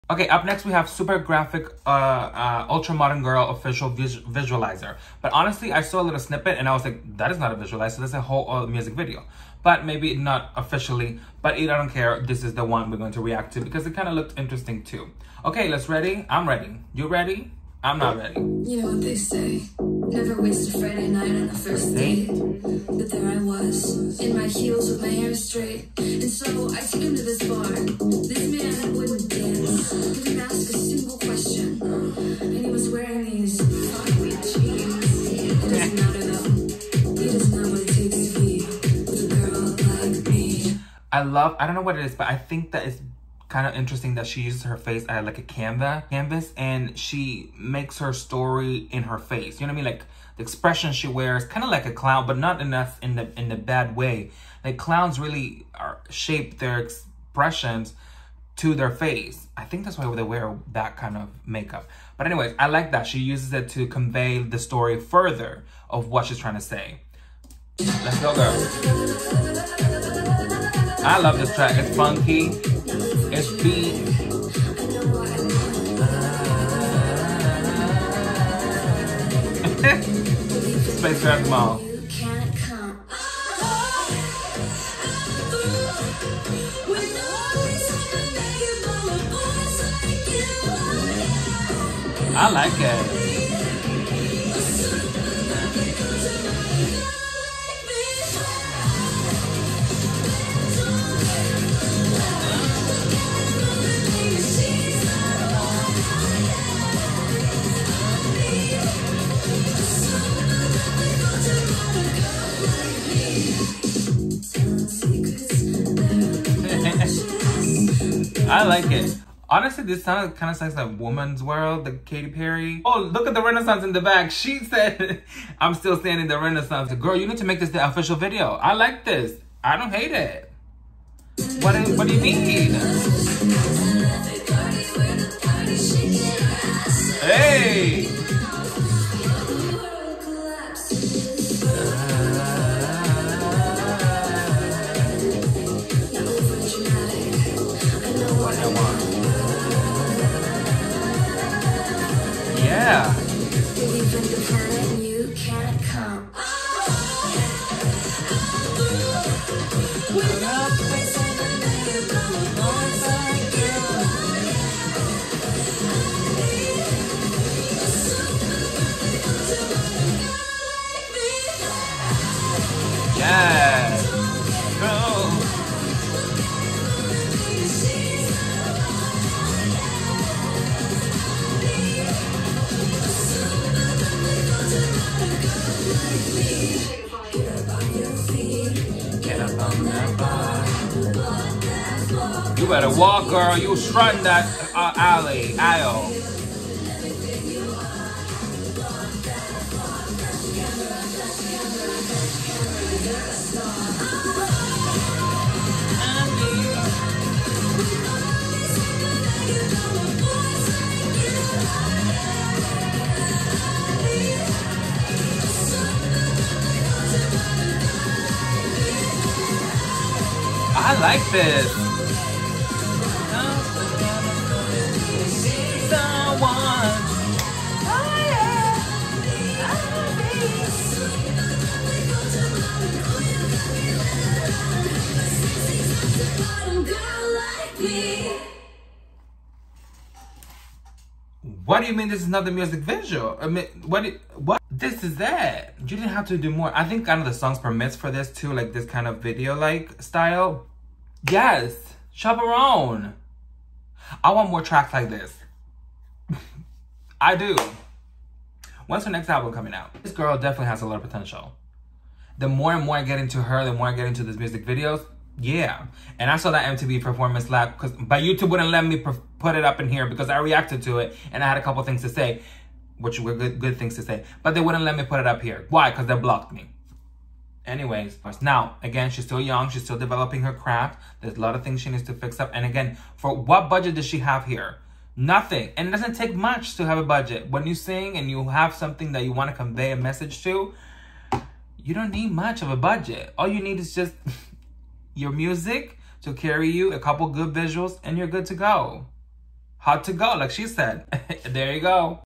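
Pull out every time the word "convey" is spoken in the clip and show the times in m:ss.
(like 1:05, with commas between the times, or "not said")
1:03, 4:49.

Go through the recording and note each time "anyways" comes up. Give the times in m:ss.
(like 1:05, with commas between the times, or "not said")
1:02, 4:37.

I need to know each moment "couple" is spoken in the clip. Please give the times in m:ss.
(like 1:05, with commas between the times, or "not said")
4:31, 4:56.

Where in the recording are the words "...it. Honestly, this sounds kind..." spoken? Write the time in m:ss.
1:58.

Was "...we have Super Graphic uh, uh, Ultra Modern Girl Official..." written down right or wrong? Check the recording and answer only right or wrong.
right.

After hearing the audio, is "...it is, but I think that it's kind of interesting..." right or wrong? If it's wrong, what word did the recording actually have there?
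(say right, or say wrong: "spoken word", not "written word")
right.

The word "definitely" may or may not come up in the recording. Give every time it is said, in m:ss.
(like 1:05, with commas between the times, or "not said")
4:20.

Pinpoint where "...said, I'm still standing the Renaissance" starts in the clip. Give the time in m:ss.
2:04.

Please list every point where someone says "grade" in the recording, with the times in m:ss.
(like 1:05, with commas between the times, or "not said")
not said.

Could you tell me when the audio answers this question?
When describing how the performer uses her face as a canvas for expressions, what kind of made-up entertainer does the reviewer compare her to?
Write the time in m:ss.
0:51.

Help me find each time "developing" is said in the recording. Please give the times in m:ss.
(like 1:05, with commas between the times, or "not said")
4:39.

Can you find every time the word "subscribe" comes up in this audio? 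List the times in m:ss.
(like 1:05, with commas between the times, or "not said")
not said.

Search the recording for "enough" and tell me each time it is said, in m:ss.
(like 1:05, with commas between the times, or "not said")
0:52.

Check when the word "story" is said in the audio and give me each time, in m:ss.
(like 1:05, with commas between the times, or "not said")
0:48, 1:04.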